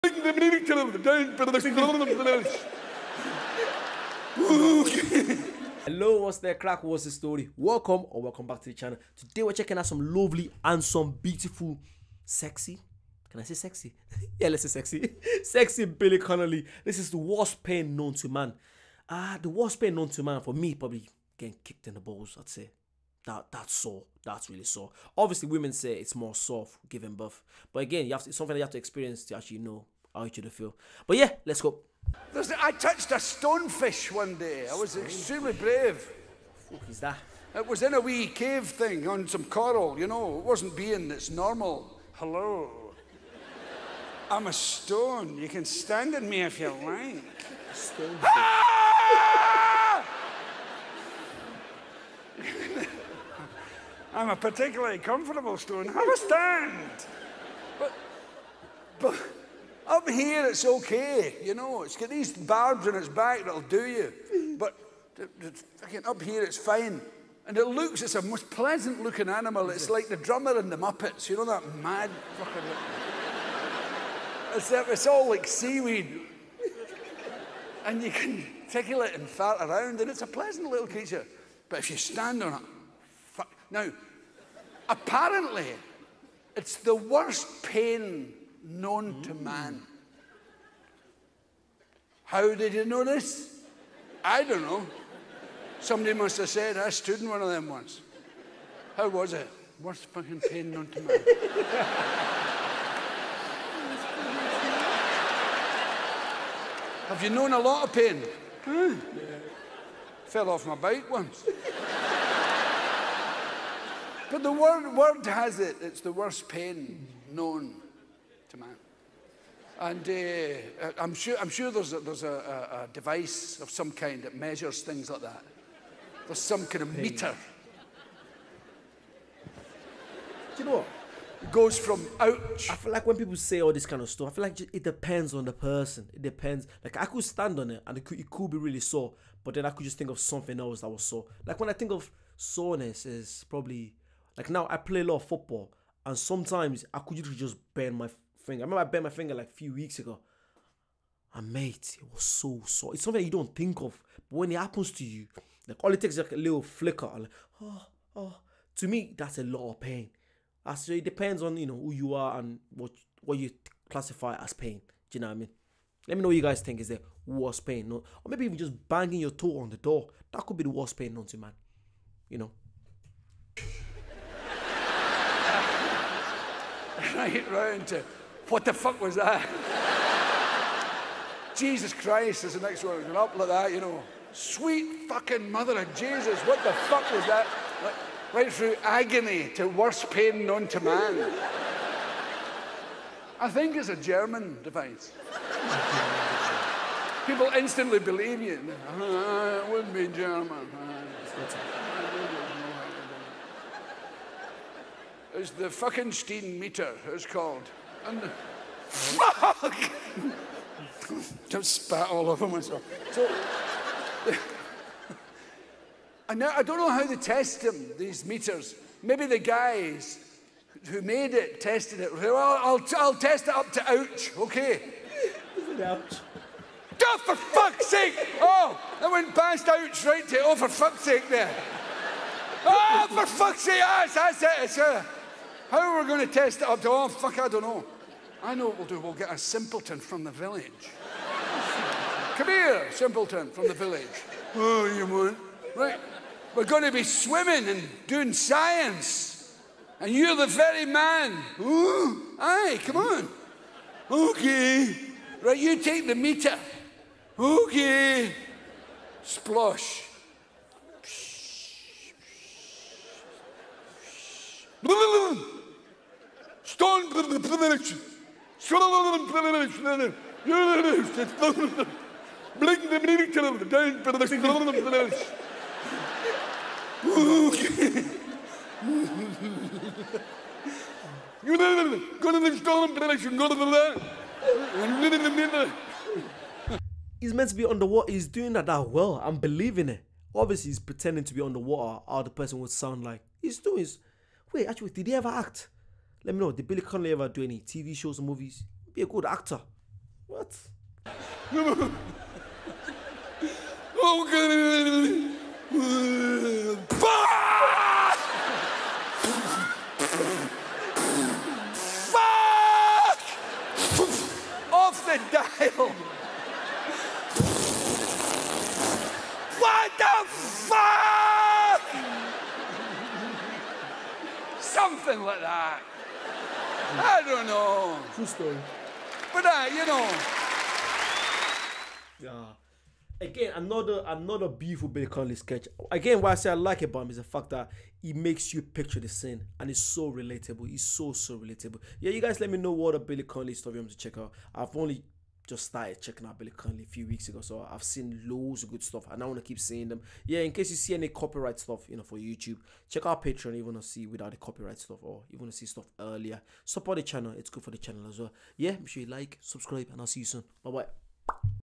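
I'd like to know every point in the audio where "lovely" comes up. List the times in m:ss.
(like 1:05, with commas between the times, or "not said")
0:10.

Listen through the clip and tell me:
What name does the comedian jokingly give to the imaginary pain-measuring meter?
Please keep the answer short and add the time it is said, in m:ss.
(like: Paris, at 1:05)
Steen meter, at 3:26.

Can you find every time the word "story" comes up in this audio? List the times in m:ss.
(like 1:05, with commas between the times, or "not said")
0:07, 5:28, 5:43.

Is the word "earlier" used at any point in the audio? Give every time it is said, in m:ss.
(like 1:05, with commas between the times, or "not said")
5:55.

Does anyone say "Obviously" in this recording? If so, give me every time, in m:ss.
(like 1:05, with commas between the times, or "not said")
0:25, 4:50.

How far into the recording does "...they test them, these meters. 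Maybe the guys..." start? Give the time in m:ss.
3:37.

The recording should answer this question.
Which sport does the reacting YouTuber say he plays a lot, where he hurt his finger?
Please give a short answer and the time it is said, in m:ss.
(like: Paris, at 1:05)
Football, at 2:25.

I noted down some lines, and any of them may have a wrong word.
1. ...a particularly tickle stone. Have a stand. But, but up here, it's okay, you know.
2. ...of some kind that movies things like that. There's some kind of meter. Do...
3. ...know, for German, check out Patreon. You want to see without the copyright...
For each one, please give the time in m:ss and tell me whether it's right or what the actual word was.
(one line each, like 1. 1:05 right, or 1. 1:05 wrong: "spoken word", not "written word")
1. 0:54 wrong: "comfortable", not "tickle"
2. 2:03 wrong: "measures", not "movies"
3. 5:51 wrong: "YouTube", not "German".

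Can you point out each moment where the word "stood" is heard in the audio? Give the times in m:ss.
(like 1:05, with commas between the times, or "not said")
1:36.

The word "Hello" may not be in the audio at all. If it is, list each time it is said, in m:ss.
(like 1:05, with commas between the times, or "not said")
0:00, 0:42.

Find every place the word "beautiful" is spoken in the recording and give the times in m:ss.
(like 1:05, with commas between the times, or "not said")
0:11, 5:34.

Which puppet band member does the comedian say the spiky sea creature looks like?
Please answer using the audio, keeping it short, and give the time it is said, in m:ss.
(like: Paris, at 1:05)
The drummer in the Muppets, at 1:10.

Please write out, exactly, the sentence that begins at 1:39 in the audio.
Worst fucking pain known to man.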